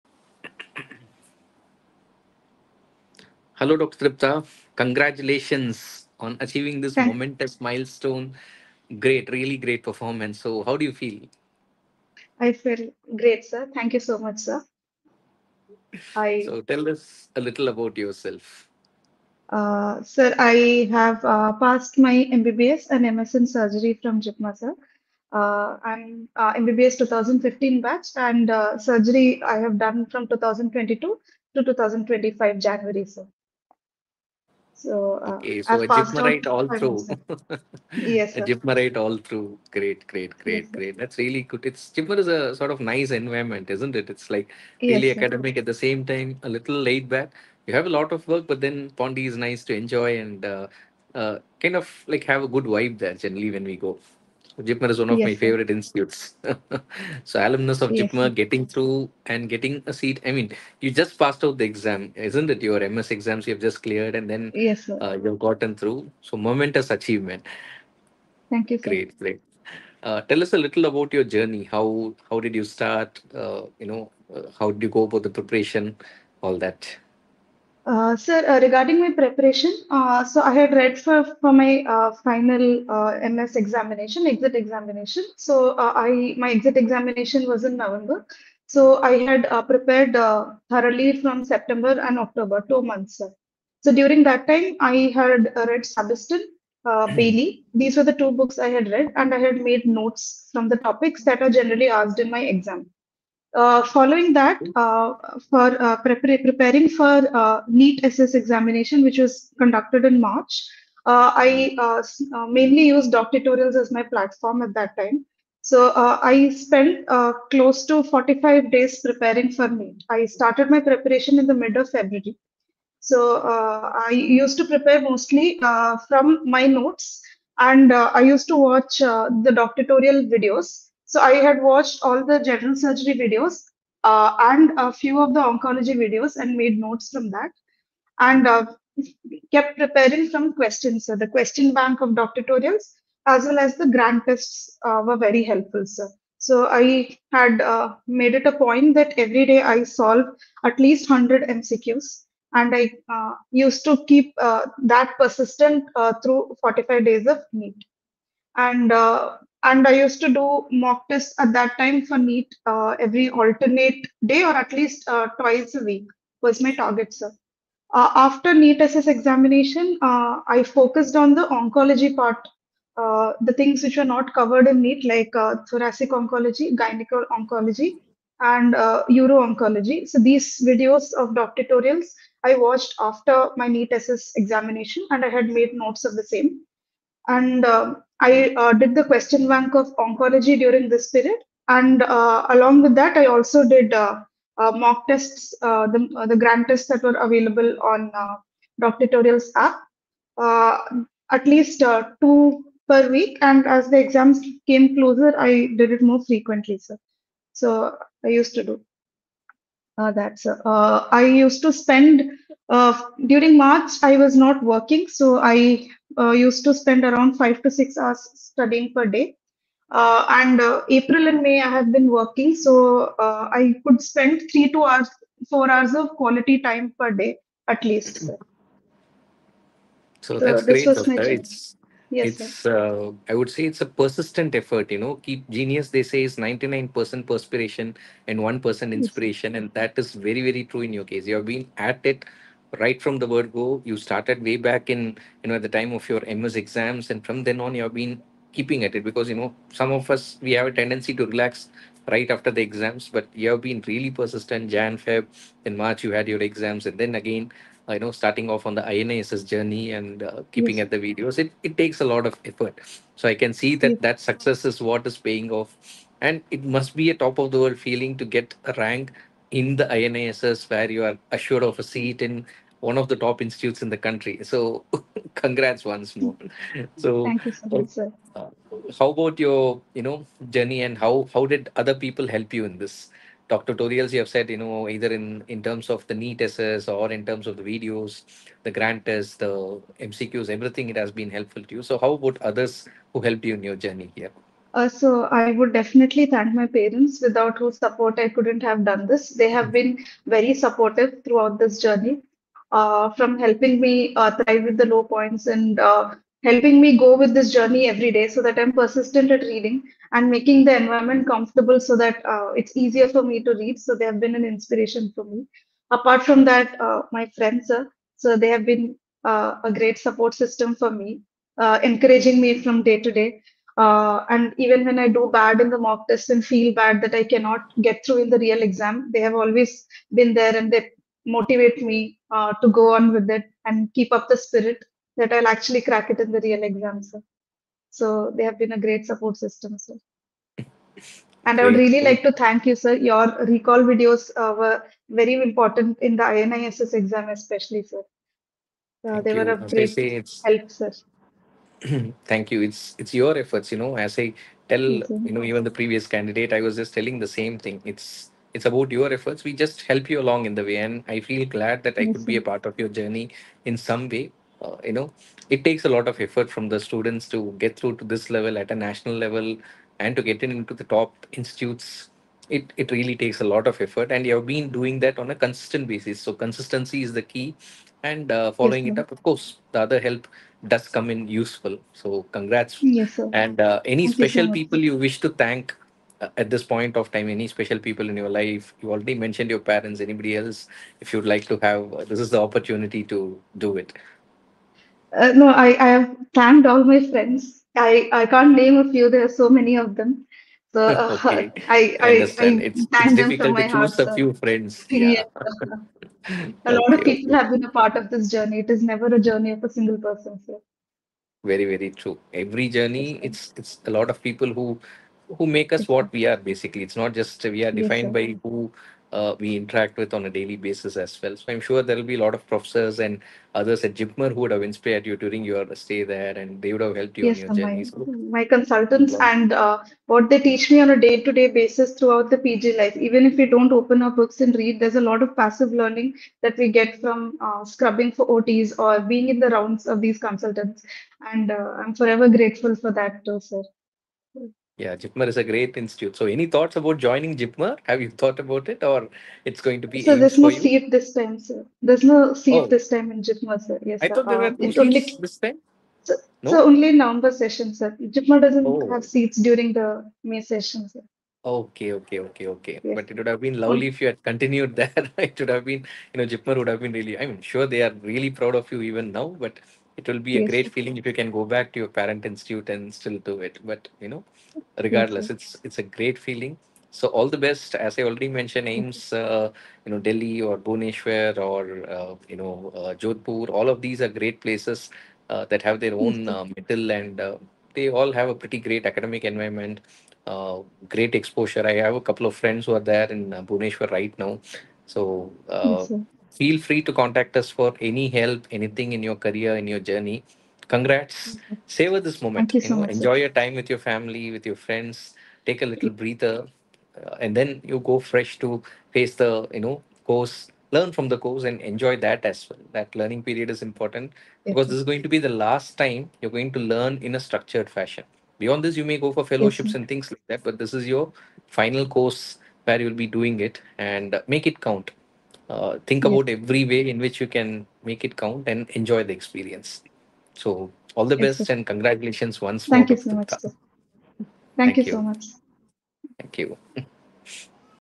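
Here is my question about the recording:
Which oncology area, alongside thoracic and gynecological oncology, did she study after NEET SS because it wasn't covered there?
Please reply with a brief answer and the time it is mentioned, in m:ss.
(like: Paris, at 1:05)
Uro-oncology, at 2:58.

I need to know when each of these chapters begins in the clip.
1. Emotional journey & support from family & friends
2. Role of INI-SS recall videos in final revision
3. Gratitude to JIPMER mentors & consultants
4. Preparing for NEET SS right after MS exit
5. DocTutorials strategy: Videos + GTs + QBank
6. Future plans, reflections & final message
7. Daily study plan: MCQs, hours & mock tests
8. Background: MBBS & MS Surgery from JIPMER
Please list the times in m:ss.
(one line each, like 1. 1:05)
1. 5:01
2. 6:00
3. 7:04
4. 1:06
5. 1:48
6. 8:00
7. 2:44
8. 0:19.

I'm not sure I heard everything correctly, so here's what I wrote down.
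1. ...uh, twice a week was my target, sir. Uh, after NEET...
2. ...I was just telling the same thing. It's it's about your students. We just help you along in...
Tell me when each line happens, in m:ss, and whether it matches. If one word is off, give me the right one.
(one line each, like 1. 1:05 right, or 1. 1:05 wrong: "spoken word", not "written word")
1. 2:45 right
2. 5:56 wrong: "efforts", not "students".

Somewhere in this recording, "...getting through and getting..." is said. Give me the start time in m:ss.
0:58.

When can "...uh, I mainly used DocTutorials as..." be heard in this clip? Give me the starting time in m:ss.
1:51.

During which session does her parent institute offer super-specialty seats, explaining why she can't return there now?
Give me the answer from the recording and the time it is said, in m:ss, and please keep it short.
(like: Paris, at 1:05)
November session, at 7:37.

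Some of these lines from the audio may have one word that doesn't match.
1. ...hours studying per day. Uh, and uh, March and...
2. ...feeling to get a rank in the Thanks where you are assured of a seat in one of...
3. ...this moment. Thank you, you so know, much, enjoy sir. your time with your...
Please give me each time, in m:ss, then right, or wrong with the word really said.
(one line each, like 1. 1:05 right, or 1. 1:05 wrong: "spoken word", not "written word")
1. 3:37 wrong: "April", not "March"
2. 4:27 wrong: "INISS", not "Thanks"
3. 8:21 right.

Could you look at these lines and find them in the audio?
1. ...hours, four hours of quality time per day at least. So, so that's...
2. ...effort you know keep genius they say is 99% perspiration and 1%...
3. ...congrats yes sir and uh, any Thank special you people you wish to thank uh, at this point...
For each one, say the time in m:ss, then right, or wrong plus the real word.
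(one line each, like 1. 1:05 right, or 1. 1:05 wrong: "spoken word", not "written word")
1. 3:44 right
2. 3:54 right
3. 6:22 right.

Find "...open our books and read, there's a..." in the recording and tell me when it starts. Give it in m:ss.
7:13.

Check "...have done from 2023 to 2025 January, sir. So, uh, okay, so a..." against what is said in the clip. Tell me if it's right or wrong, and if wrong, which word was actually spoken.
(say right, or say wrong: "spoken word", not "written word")
wrong: "2022", not "2023".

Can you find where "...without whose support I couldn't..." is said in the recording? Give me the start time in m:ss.
4:57.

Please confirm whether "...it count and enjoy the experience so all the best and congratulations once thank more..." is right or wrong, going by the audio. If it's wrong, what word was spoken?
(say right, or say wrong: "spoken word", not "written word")
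right.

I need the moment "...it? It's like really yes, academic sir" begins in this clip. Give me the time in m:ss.
0:43.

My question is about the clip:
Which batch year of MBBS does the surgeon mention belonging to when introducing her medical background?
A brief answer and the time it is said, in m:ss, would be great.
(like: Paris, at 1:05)
2015, at 0:26.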